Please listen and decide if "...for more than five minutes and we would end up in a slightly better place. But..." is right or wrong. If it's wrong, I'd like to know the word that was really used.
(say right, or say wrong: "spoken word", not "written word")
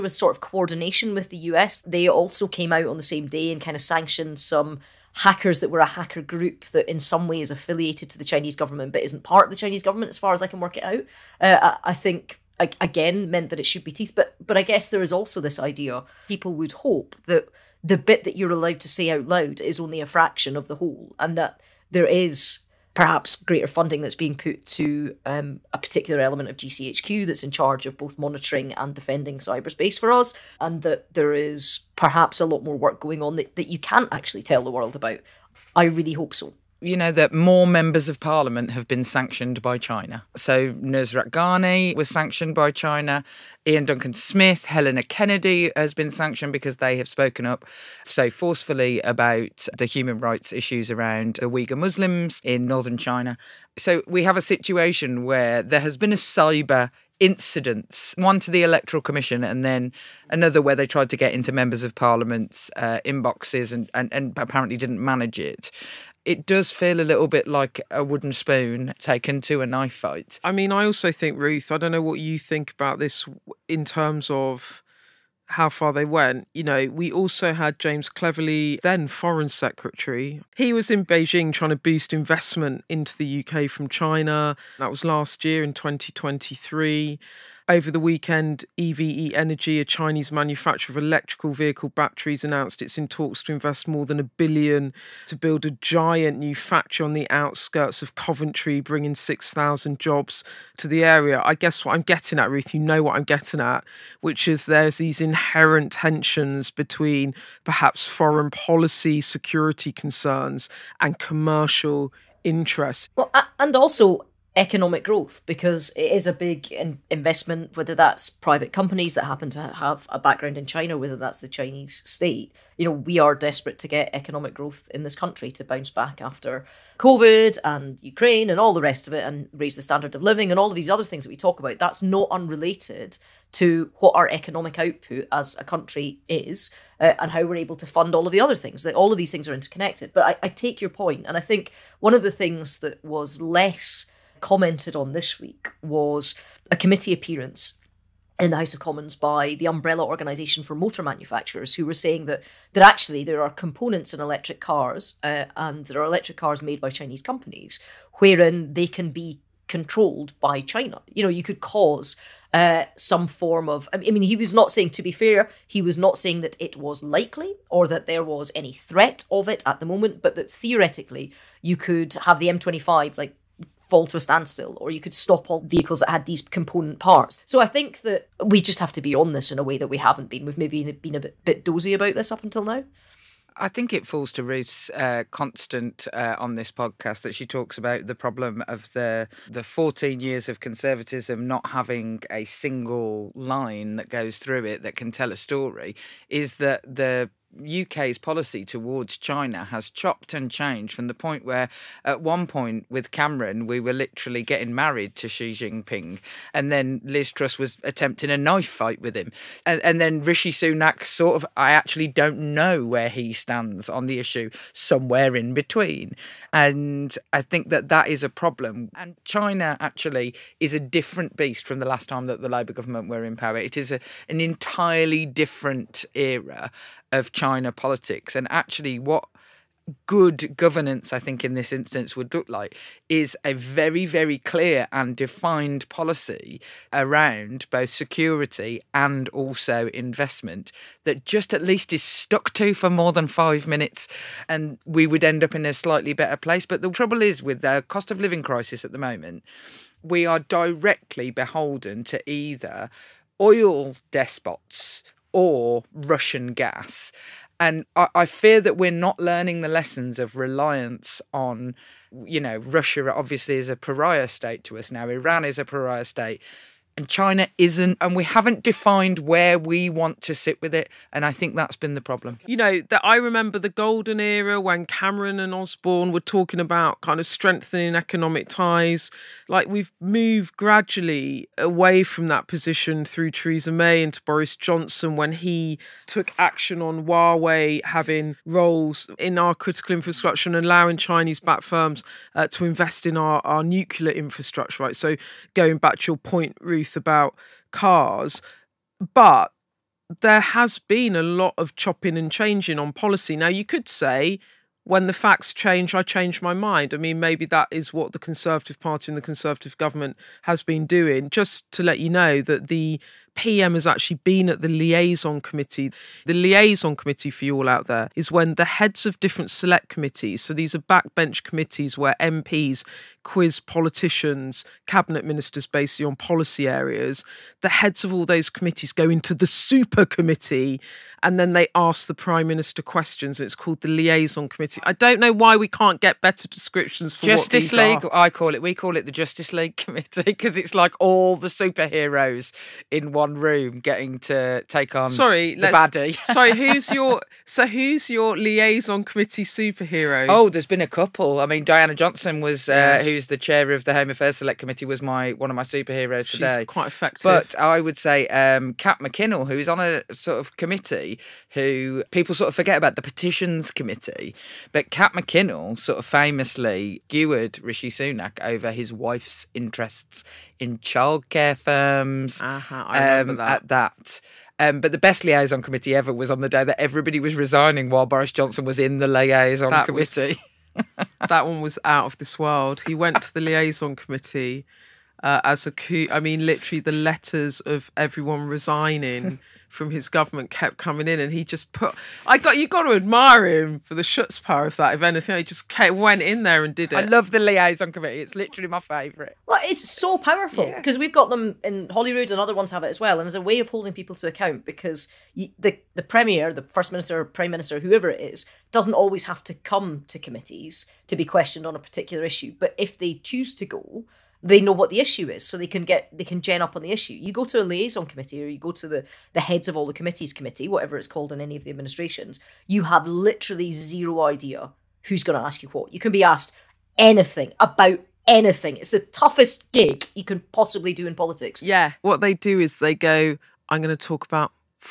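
right.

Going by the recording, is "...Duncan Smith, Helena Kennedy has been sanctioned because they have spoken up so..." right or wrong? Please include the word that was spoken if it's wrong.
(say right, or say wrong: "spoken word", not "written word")
right.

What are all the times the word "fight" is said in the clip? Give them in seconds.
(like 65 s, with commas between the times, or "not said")
69 s, 208 s.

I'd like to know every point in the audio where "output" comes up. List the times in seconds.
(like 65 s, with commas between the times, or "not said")
134 s.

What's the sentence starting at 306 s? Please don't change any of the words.
I mean, maybe that is what the Conservative Party and the Conservative government has been doing.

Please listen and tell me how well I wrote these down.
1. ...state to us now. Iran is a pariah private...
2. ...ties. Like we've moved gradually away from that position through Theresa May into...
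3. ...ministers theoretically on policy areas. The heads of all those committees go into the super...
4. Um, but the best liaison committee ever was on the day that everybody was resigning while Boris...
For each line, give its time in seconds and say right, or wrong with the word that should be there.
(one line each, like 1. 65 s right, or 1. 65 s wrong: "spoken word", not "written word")
1. 264 s wrong: "state", not "private"
2. 278 s right
3. 325 s wrong: "basically", not "theoretically"
4. 374 s right.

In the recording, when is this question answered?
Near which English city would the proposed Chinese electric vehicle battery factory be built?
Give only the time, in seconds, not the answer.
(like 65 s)
98 s.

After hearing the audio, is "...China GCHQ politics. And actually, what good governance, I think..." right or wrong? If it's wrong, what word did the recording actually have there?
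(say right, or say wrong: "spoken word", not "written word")
wrong: "China", not "GCHQ".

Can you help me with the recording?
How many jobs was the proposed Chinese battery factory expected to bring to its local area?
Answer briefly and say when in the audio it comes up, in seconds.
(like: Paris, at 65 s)
6,000, at 99 s.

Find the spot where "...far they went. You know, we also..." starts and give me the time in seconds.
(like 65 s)
75 s.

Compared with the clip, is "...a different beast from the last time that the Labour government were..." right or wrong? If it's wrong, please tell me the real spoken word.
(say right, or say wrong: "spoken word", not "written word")
right.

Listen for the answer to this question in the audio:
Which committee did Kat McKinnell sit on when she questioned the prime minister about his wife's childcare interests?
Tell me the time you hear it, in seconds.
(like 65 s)
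363 s.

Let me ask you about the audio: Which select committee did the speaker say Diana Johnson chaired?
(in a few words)
Home Affairs Select Committee.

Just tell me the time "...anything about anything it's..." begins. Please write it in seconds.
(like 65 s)
426 s.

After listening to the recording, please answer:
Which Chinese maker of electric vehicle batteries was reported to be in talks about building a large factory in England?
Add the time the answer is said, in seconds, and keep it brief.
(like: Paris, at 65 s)
EVE Energy, at 88 s.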